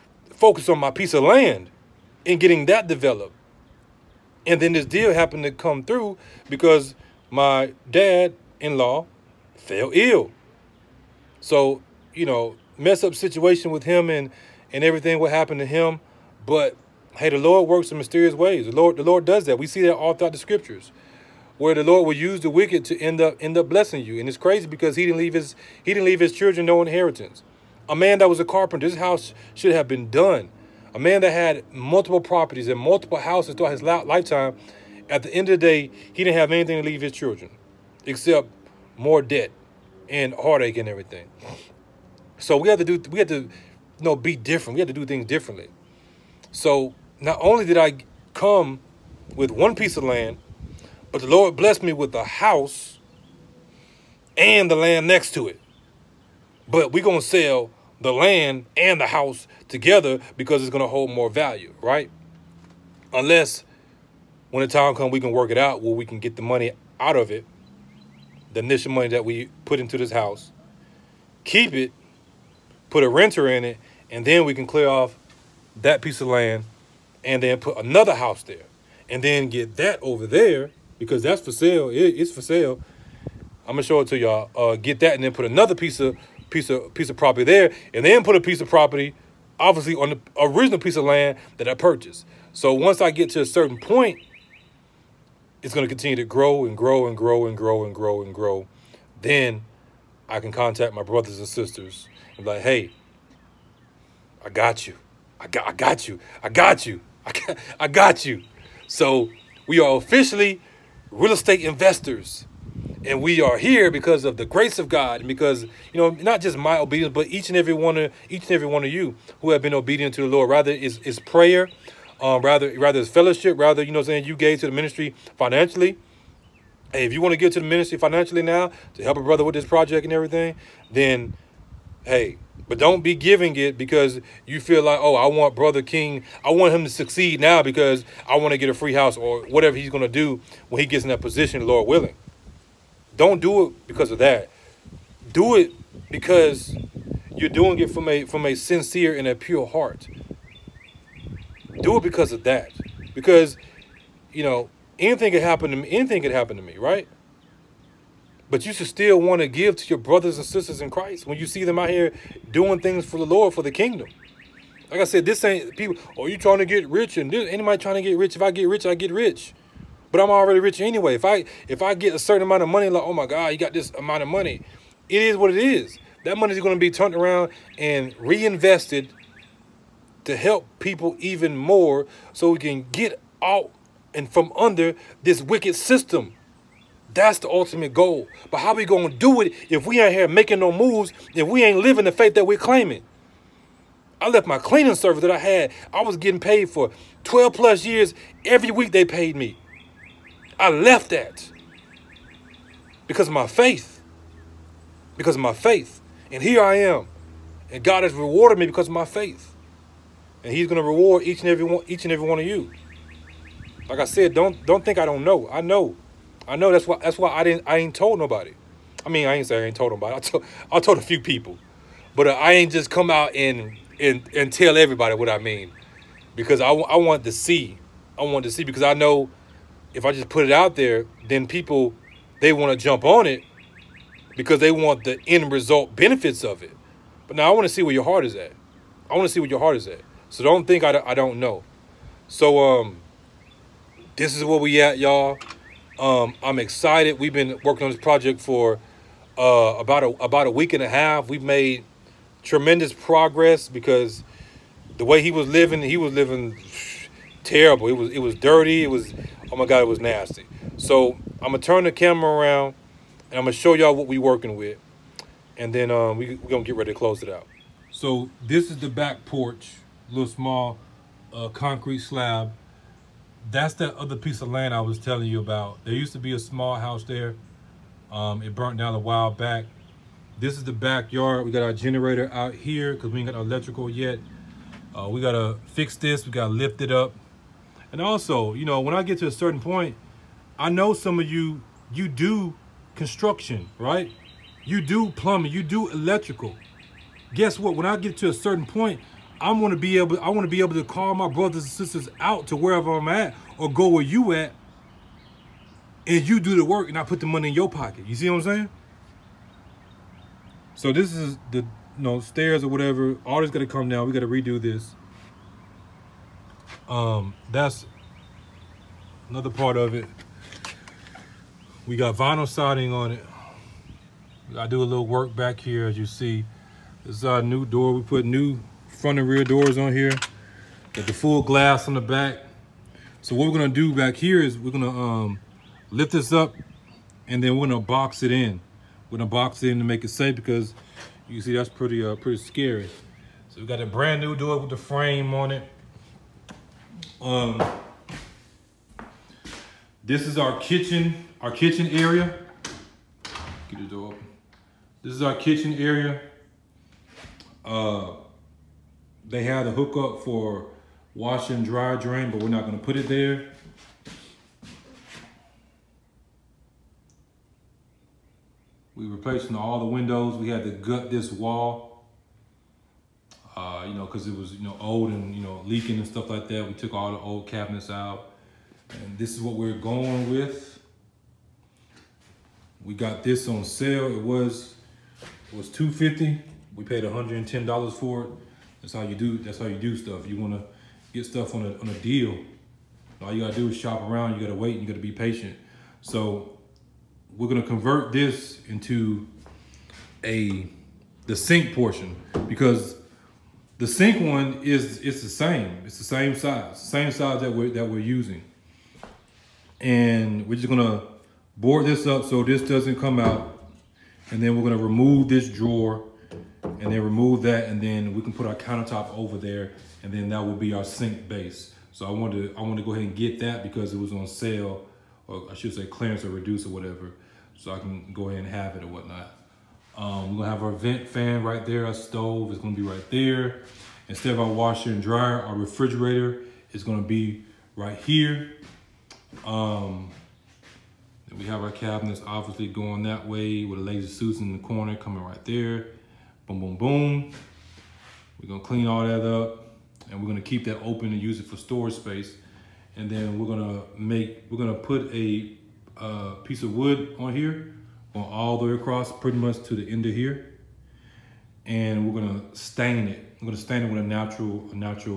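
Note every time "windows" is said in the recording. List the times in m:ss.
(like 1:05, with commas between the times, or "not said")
6:09.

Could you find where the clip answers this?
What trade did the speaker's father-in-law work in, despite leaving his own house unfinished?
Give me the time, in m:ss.
0:28.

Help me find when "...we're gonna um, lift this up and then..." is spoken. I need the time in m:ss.
5:34.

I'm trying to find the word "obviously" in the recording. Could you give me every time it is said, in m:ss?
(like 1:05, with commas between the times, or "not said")
1:29, 7:22.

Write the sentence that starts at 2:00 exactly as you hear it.
Rather is is prayer, um, rather rather is fellowship, rather, you know I'm saying, you gave to the ministry financially.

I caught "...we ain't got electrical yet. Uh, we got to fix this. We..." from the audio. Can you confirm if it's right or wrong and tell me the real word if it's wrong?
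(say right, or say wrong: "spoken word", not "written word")
right.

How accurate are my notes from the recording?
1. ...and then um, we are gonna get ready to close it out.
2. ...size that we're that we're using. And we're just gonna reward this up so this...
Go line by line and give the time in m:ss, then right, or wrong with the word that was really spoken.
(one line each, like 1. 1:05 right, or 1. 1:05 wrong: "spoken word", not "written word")
1. 4:25 right
2. 6:47 wrong: "board", not "reward".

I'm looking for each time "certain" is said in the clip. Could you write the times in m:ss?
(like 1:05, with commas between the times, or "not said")
1:33, 2:52, 4:49, 4:58.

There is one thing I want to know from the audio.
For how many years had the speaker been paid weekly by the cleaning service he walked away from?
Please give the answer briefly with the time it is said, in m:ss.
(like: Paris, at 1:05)
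12 plus years, at 3:17.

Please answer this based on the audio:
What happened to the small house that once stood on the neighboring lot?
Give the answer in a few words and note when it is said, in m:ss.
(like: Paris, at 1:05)
It burnt down, at 4:38.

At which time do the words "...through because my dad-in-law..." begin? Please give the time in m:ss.
0:05.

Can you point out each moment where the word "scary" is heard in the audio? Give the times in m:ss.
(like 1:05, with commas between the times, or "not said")
5:42.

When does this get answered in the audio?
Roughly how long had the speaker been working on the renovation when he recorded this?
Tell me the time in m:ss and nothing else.
4:10.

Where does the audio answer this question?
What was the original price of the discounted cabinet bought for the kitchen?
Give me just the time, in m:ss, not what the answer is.
6:25.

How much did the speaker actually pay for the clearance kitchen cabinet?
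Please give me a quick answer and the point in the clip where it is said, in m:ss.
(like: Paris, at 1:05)
$110, at 6:27.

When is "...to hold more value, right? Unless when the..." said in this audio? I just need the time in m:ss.
1:00.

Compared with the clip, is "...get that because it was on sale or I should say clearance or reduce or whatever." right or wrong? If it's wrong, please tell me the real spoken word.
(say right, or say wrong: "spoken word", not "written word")
right.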